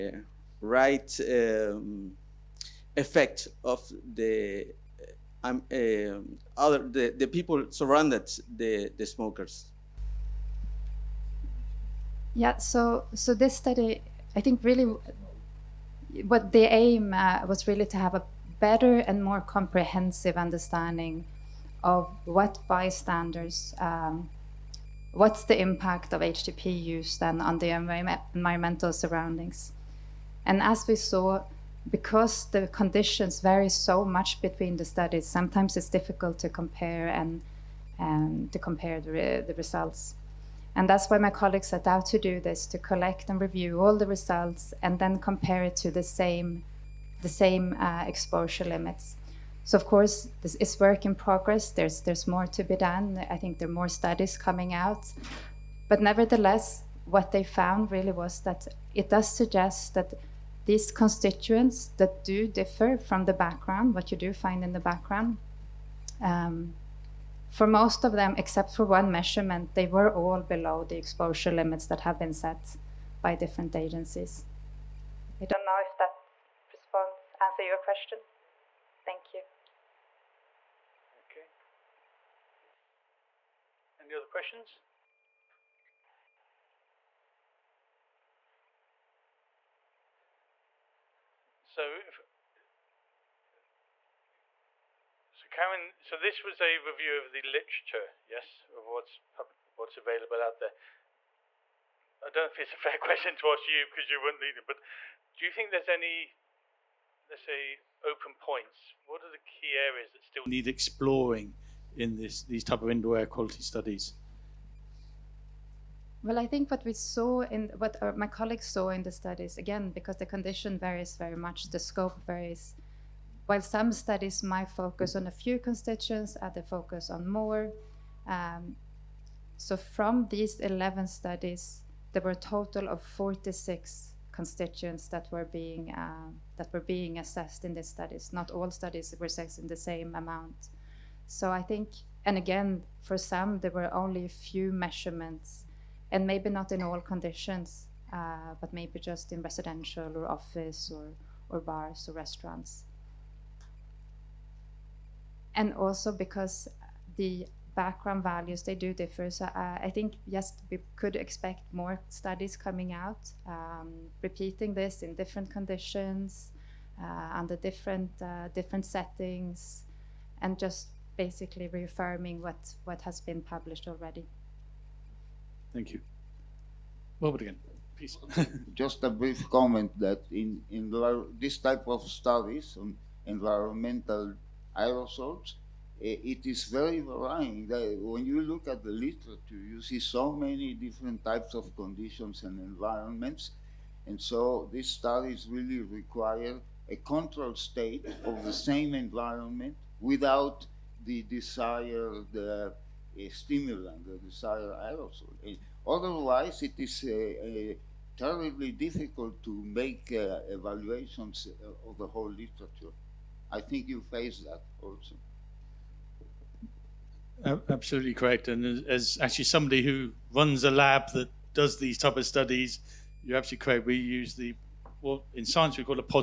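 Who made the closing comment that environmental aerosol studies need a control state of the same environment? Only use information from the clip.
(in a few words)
Robert.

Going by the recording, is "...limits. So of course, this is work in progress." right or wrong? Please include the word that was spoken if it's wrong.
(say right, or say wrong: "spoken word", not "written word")
right.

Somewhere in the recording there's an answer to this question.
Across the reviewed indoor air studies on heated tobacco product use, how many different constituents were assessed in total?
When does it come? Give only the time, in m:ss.
2:13.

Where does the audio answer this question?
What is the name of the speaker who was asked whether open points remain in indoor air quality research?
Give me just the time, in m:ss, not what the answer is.
1:35.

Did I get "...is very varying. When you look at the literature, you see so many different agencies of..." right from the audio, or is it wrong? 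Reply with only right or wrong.
wrong.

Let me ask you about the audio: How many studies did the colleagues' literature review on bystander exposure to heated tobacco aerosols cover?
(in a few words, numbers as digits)
11.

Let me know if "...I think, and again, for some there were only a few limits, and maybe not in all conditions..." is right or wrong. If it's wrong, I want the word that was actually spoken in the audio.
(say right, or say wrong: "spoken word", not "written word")
wrong: "measurements", not "limits".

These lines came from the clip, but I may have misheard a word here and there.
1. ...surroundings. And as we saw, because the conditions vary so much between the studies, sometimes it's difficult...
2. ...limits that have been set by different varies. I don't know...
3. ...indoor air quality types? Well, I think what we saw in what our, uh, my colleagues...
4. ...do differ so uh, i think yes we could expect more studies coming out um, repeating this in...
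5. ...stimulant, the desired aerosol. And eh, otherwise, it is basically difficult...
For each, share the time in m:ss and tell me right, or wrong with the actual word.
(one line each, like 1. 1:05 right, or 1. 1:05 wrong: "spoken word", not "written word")
1. 0:28 right
2. 1:11 wrong: "agencies", not "varies"
3. 1:52 wrong: "studies", not "types"
4. 2:38 right
5. 3:23 wrong: "terribly", not "basically".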